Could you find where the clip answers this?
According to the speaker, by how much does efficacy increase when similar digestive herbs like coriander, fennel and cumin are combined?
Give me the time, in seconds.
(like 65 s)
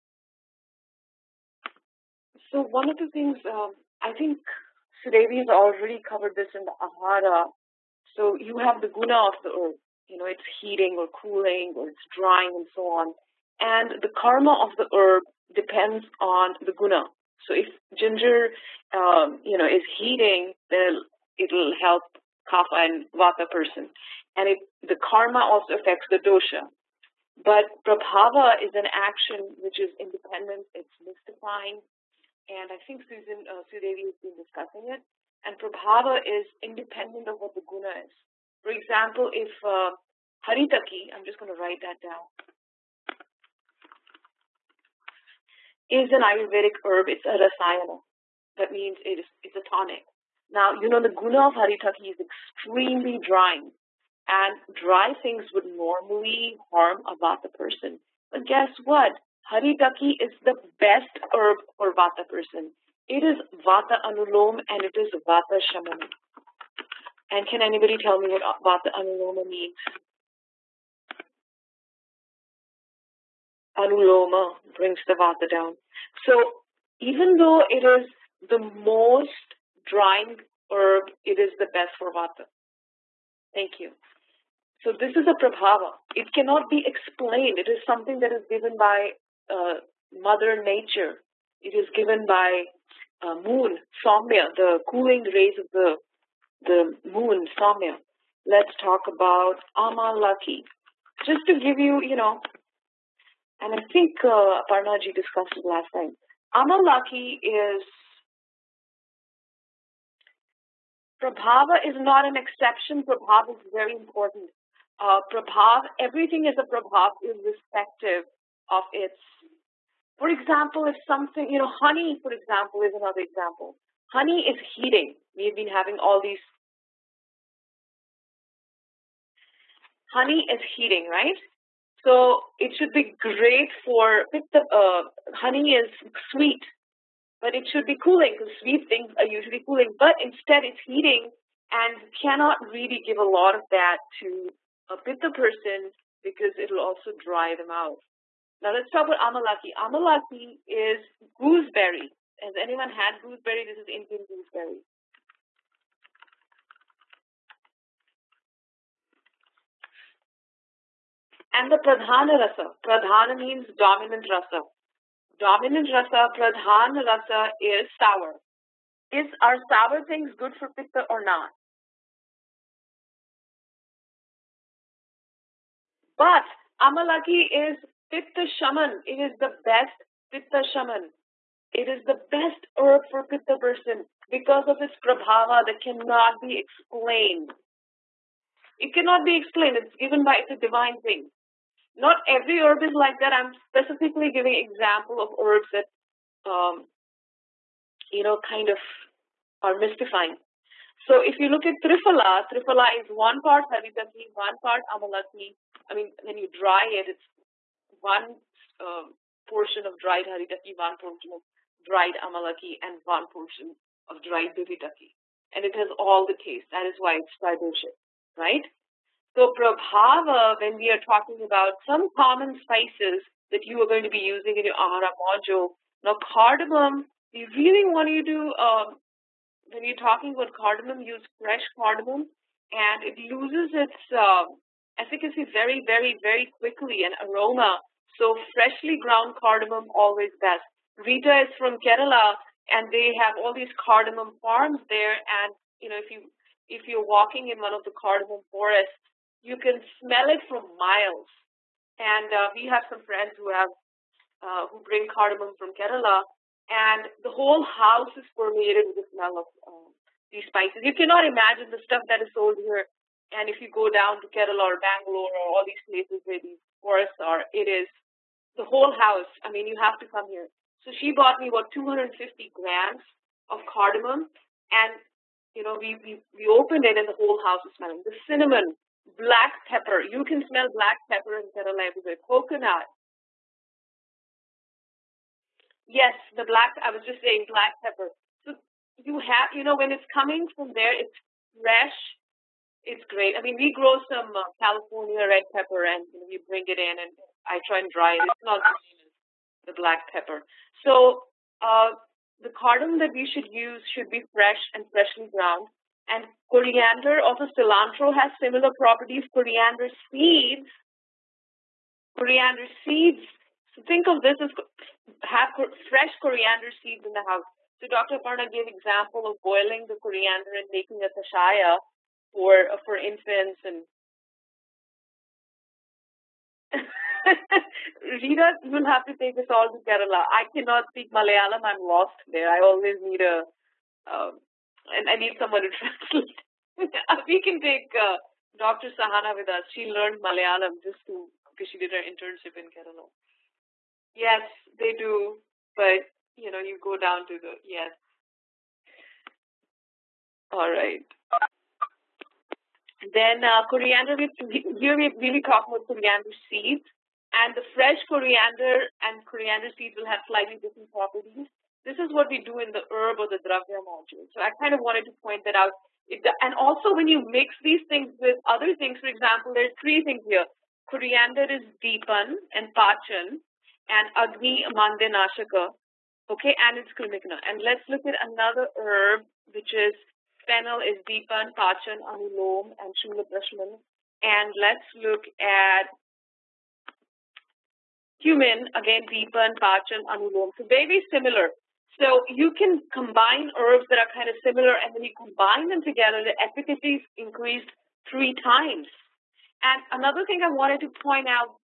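398 s.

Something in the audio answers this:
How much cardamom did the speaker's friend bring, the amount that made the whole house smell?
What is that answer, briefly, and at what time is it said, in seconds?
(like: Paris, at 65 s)
250 grams, at 271 s.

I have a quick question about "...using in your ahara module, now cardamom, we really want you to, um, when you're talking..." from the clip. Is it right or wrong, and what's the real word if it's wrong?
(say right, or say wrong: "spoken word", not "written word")
right.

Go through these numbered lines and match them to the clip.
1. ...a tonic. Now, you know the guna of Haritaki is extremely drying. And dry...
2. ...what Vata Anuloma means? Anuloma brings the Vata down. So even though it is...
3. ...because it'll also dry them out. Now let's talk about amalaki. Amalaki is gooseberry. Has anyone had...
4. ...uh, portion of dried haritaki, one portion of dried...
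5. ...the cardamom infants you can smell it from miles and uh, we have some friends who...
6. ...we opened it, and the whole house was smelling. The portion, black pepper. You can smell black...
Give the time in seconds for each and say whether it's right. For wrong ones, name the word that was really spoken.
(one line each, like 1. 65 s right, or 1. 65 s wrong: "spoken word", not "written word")
1. 49 s right
2. 68 s right
3. 146 s right
4. 208 s right
5. 247 s wrong: "forests", not "infants"
6. 276 s wrong: "cinnamon", not "portion".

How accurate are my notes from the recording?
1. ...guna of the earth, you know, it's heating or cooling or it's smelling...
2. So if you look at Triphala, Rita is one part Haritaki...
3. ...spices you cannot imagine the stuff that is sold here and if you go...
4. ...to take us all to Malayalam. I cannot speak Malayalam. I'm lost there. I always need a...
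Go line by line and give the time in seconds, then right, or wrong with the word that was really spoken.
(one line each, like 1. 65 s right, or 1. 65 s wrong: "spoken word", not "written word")
1. 8 s wrong: "drying", not "smelling"
2. 201 s wrong: "Triphala", not "Rita"
3. 260 s right
4. 329 s wrong: "Kerala", not "Malayalam".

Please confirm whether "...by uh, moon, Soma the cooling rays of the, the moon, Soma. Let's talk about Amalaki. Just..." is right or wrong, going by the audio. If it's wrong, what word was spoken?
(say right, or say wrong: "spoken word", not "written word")
right.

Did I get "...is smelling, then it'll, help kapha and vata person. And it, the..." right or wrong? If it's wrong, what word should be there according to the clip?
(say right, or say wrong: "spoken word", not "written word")
wrong: "heating", not "smelling".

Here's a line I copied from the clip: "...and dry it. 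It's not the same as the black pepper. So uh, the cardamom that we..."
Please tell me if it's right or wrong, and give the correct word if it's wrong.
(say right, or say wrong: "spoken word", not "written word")
right.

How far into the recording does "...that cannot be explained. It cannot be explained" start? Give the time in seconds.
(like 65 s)
185 s.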